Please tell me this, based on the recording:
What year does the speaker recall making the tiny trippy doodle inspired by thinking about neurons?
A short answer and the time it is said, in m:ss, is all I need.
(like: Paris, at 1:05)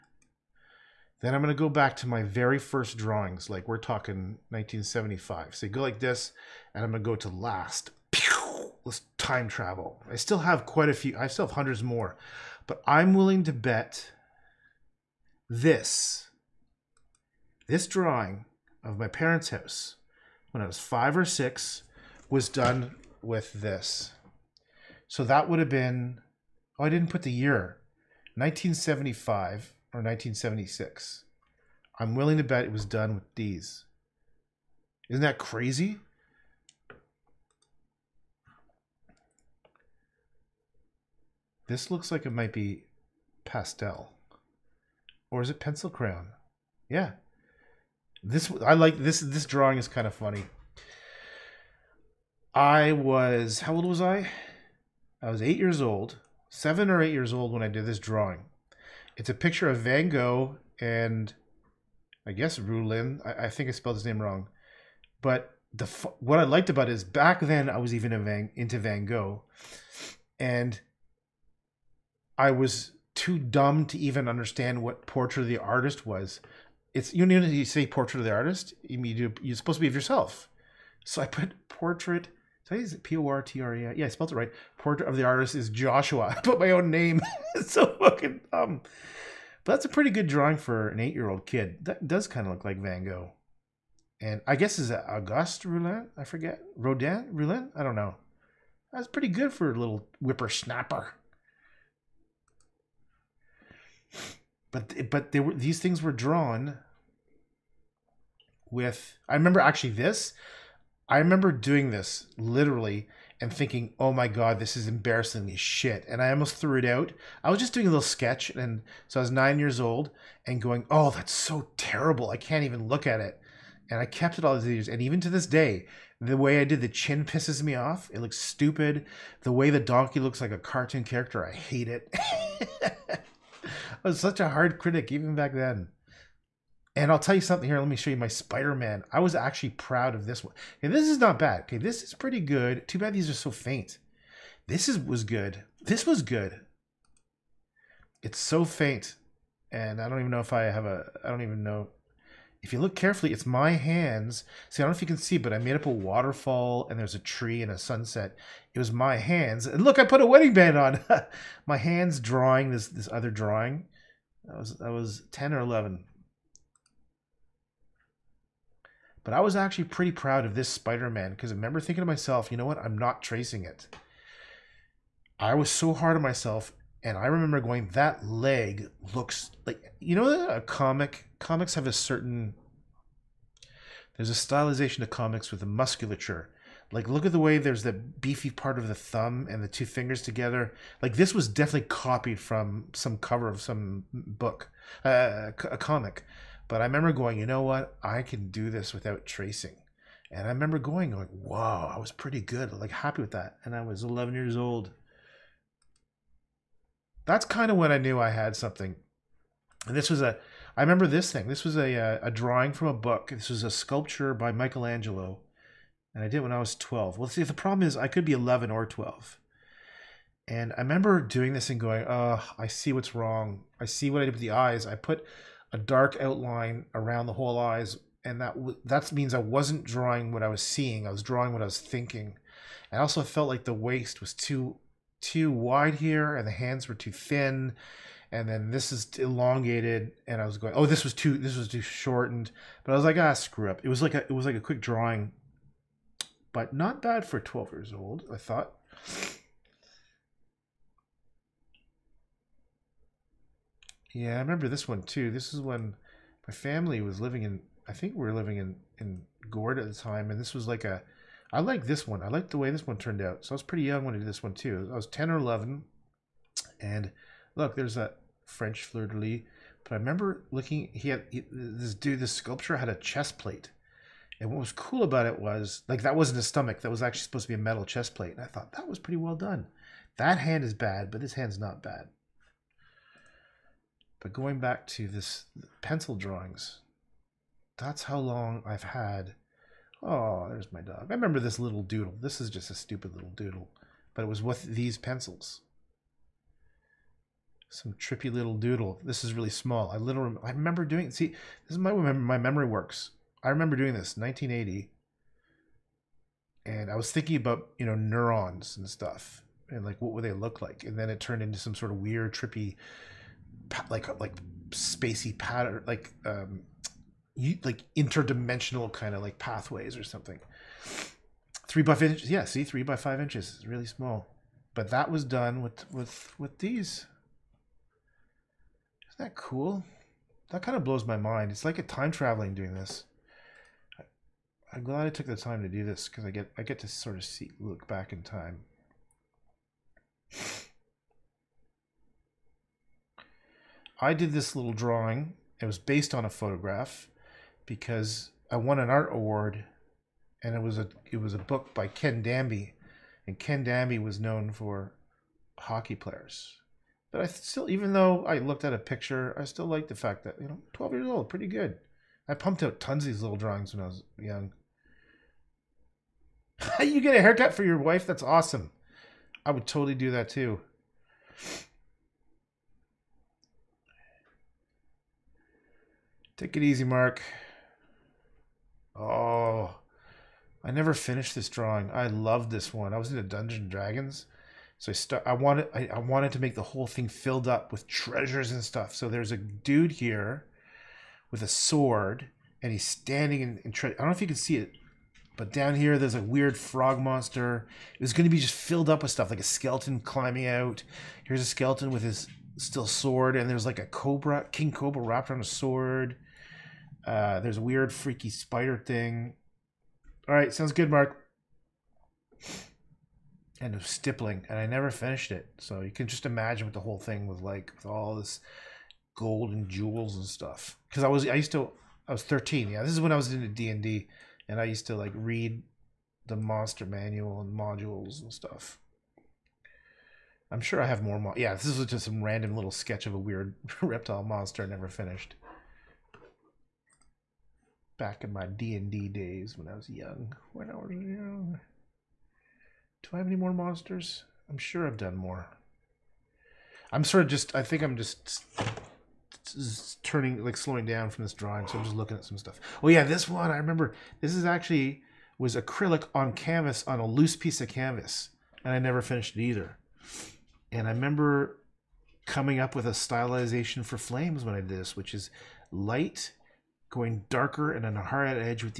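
1980, at 5:04.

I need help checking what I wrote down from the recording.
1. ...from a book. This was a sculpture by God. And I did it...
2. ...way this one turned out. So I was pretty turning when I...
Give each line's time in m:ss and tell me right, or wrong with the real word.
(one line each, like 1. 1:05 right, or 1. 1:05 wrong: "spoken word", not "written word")
1. 3:32 wrong: "Michelangelo", not "God"
2. 4:22 wrong: "young", not "turning".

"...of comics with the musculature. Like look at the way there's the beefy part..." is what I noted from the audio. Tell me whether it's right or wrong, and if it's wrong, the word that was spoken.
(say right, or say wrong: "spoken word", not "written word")
right.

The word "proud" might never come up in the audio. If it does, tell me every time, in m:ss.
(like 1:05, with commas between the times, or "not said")
2:19, 2:50.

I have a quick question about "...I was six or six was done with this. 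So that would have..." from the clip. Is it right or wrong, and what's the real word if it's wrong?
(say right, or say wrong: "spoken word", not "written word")
wrong: "five", not "six".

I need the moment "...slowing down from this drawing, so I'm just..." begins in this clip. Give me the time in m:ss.
7:30.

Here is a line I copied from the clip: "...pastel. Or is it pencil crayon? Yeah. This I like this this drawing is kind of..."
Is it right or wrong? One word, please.
right.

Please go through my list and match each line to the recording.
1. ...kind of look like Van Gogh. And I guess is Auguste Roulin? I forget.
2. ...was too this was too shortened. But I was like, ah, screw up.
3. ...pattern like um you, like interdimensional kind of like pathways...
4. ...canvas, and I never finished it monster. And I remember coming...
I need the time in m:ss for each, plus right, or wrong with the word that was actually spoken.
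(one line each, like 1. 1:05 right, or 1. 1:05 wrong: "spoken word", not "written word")
1. 1:32 right
2. 4:01 right
3. 5:15 right
4. 7:37 wrong: "either", not "monster".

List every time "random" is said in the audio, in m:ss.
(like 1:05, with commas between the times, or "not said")
7:12.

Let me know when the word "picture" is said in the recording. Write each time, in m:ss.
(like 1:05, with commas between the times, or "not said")
0:59, 5:58.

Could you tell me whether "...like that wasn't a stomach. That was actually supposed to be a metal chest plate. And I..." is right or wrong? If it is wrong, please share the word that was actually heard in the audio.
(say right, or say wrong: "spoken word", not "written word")
right.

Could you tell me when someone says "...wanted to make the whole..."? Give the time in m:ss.
6:25.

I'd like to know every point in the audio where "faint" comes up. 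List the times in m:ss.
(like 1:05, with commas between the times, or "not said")
2:23, 2:28.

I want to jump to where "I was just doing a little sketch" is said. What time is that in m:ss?
1:57.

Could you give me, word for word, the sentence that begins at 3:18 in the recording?
I can do this without tracing.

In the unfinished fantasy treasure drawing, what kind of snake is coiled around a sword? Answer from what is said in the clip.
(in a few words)
king cobra.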